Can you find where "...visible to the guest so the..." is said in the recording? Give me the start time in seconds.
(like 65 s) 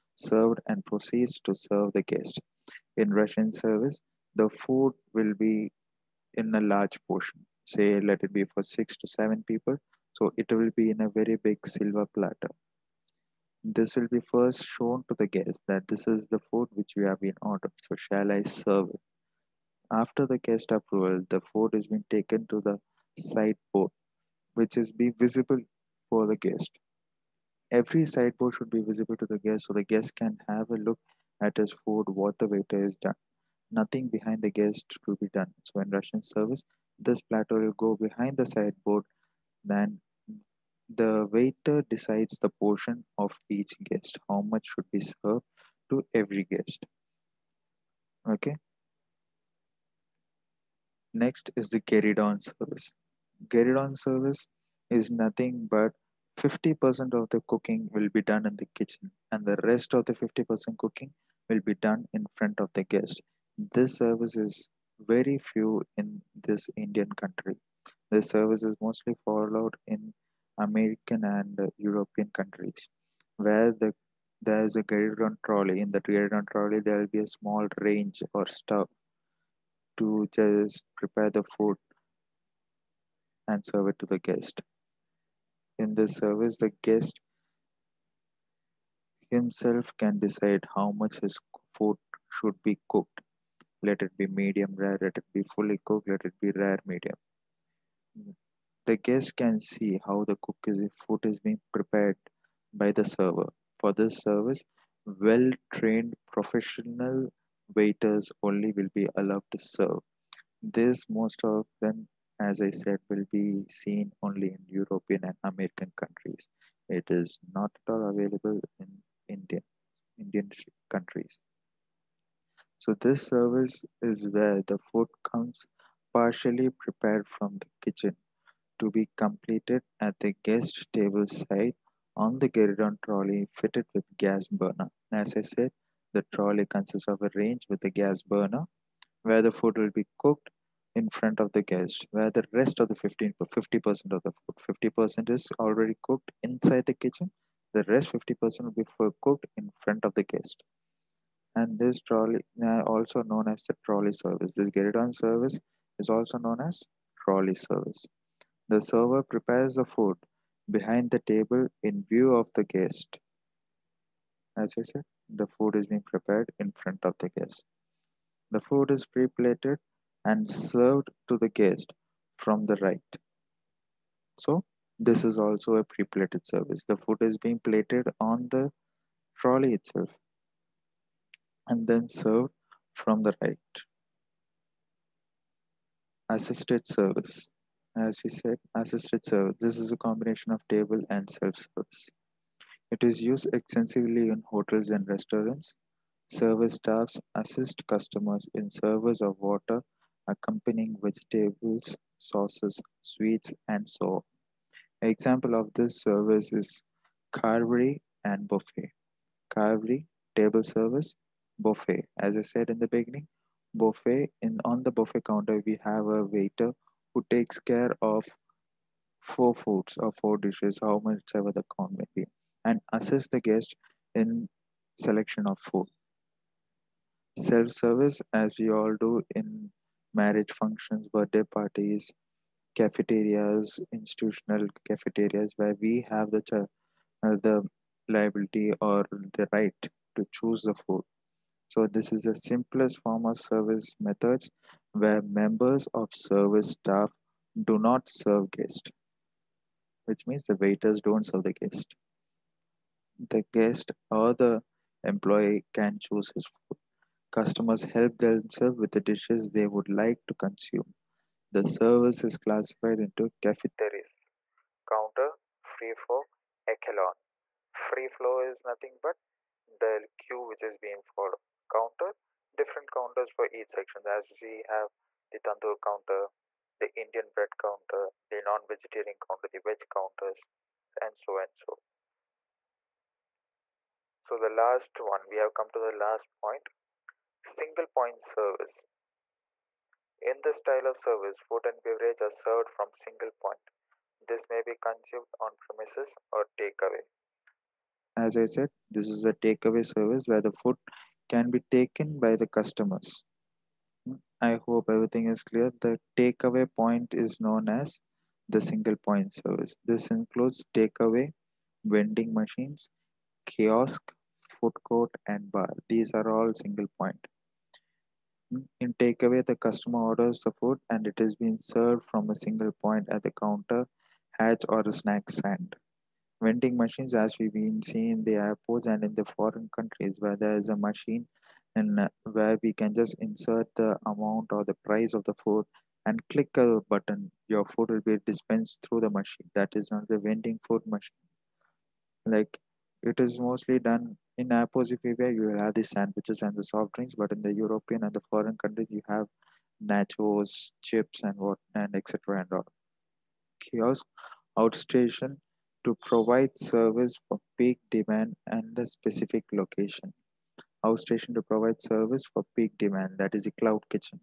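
28 s.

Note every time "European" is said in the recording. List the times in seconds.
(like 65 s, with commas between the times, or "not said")
71 s, 114 s, 347 s.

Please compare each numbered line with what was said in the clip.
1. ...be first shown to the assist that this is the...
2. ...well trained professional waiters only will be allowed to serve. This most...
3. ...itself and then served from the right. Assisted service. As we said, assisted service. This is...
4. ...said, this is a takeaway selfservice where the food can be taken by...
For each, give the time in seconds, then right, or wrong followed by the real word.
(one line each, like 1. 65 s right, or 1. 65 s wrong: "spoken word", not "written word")
1. 14 s wrong: "guest", not "assist"
2. 105 s right
3. 179 s right
4. 298 s wrong: "service", not "selfservice".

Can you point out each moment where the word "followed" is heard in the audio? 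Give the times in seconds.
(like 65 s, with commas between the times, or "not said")
69 s, 271 s.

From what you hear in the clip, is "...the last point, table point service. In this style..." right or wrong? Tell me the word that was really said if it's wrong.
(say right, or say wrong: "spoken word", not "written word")
wrong: "single", not "table".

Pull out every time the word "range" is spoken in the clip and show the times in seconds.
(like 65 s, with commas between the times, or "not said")
77 s, 137 s.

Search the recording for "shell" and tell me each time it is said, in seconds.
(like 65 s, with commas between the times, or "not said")
not said.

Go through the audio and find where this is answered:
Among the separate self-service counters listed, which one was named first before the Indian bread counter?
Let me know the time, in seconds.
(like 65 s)
275 s.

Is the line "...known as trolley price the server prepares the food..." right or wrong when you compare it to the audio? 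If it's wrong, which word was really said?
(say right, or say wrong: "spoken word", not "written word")
wrong: "service", not "price".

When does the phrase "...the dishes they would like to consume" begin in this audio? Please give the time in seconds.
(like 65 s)
258 s.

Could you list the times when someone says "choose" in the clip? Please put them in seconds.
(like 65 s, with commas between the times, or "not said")
240 s, 255 s.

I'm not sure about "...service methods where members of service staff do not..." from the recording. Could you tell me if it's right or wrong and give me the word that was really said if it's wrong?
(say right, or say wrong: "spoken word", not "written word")
right.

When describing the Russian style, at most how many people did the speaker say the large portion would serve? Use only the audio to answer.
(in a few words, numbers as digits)
7.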